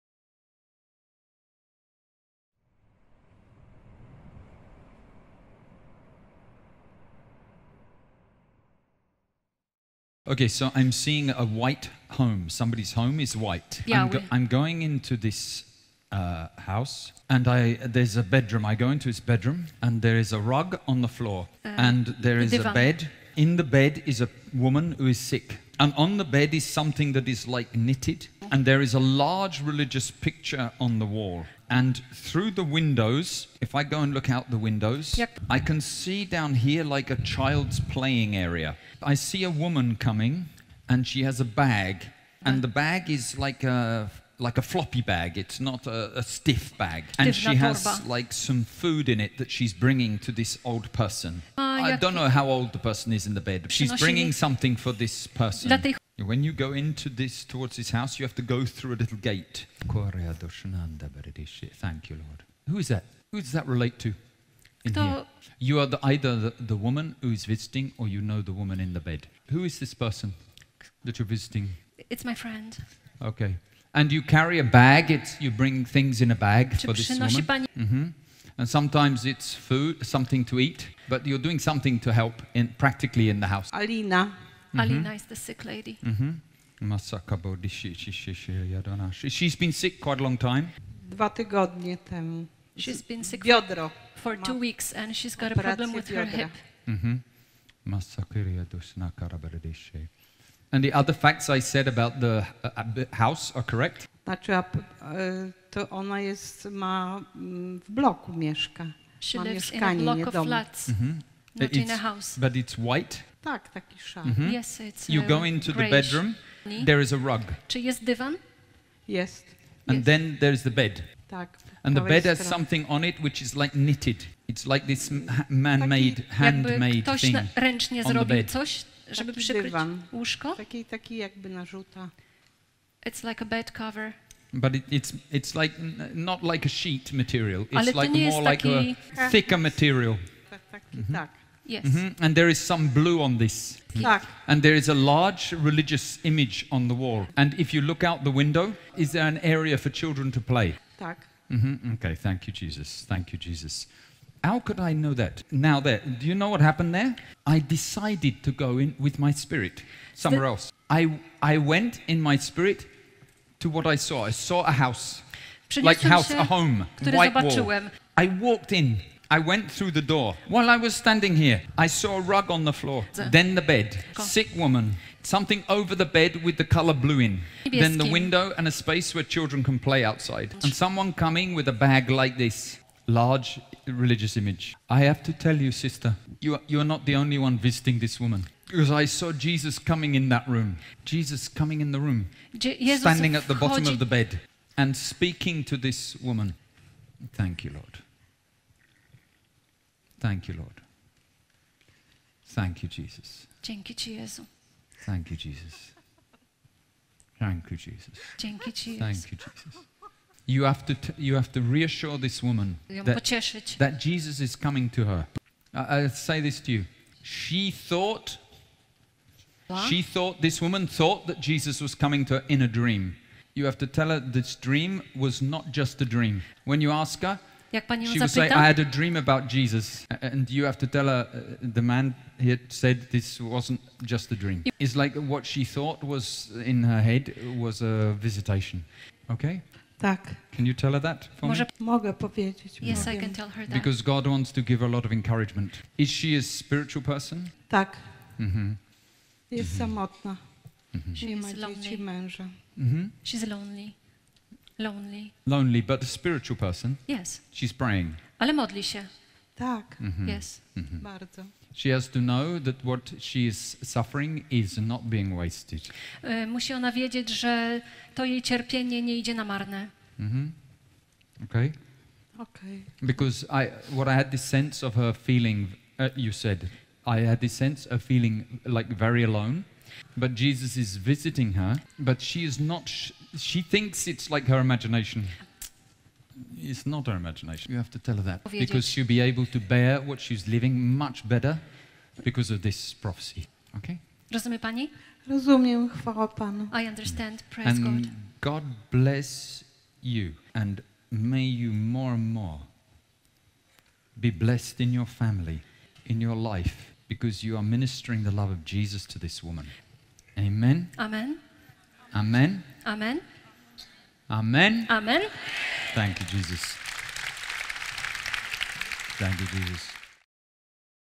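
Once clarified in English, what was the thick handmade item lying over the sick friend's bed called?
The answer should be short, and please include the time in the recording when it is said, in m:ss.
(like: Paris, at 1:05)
Bed cover, at 2:13.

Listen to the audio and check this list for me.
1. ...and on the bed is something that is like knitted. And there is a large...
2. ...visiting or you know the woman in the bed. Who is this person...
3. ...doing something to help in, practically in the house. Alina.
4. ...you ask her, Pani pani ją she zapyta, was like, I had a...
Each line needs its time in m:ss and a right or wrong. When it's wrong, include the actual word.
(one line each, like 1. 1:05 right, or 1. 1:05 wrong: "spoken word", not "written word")
1. 0:25 right
2. 1:07 right
3. 1:21 right
4. 3:46 wrong: "Jak", not "Pani".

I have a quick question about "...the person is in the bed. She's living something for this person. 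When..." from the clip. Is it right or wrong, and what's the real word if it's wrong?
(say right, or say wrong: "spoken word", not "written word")
wrong: "bringing", not "living".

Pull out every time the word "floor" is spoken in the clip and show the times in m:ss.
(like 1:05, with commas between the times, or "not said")
0:21, 2:52.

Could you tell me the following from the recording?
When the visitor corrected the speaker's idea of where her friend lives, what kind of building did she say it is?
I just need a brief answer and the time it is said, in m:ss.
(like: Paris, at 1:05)
Block of flats, at 1:49.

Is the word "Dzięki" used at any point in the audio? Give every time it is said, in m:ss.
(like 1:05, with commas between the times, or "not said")
3:23, 3:28.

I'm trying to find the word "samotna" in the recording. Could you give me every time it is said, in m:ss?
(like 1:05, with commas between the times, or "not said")
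4:09.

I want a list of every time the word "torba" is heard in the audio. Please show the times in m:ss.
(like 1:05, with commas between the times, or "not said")
0:47.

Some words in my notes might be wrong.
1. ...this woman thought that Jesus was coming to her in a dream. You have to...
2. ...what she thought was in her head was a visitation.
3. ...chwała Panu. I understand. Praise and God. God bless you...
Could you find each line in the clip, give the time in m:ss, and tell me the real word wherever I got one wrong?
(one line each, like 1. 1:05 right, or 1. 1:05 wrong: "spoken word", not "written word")
1. 3:40 right
2. 3:55 right
3. 4:55 right.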